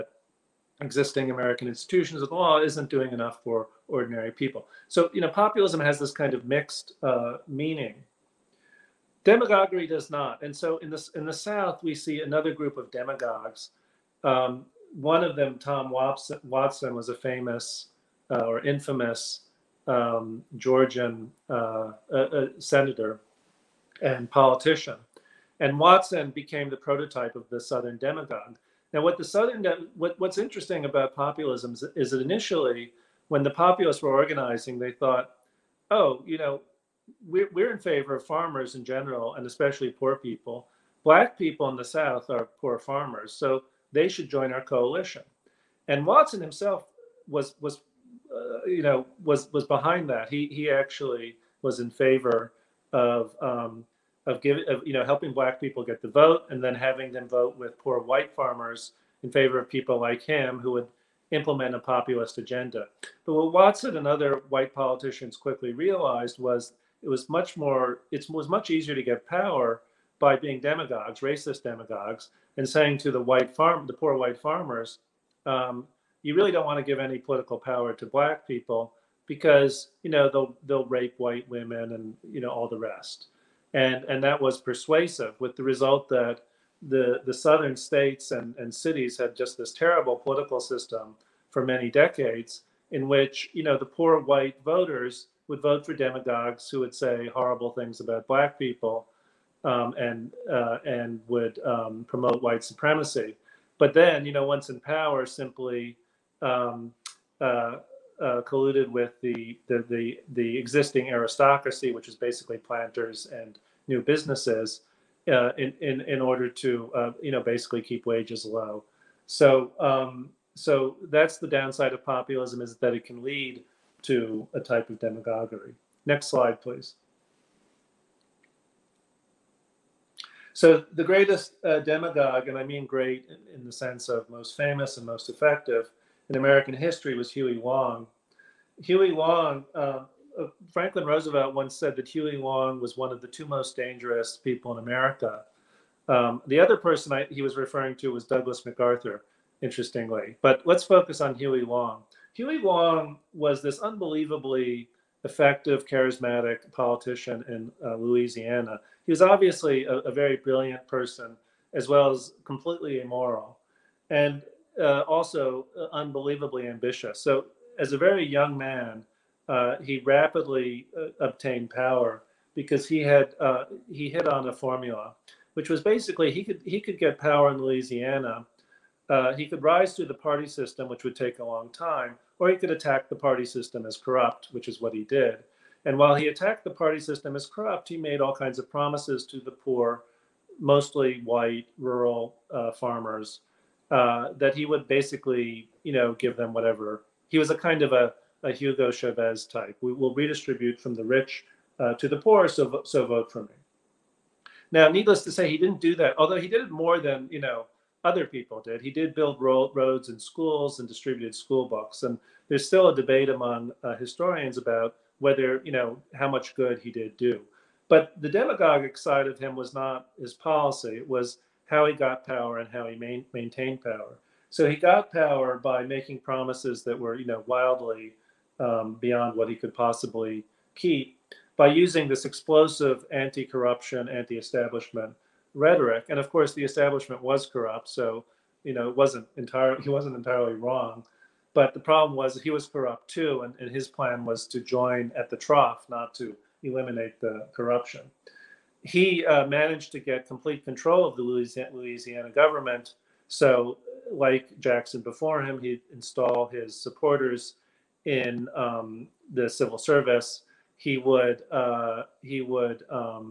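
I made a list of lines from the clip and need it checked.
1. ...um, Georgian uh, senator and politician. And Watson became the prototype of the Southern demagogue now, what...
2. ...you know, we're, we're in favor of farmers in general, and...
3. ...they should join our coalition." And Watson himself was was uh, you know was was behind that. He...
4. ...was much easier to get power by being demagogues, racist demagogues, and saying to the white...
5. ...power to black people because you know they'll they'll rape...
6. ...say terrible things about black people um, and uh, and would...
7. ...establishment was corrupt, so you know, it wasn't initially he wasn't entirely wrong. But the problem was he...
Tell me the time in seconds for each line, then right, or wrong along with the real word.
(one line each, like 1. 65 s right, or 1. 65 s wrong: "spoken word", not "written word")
1. 19 s right
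2. 36 s right
3. 43 s right
4. 68 s right
5. 77 s right
6. 96 s wrong: "horrible", not "terrible"
7. 236 s wrong: "entirely", not "initially".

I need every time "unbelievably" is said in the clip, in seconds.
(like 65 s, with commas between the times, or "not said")
153 s, 165 s.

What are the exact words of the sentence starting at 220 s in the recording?
It was how he got power and how he main, maintained power.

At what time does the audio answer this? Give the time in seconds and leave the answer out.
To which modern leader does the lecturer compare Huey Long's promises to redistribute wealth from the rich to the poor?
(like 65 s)
198 s.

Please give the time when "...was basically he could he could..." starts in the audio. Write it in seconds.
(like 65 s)
175 s.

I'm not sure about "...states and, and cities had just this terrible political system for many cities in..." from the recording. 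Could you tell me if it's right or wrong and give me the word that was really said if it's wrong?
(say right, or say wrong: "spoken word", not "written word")
wrong: "decades", not "cities".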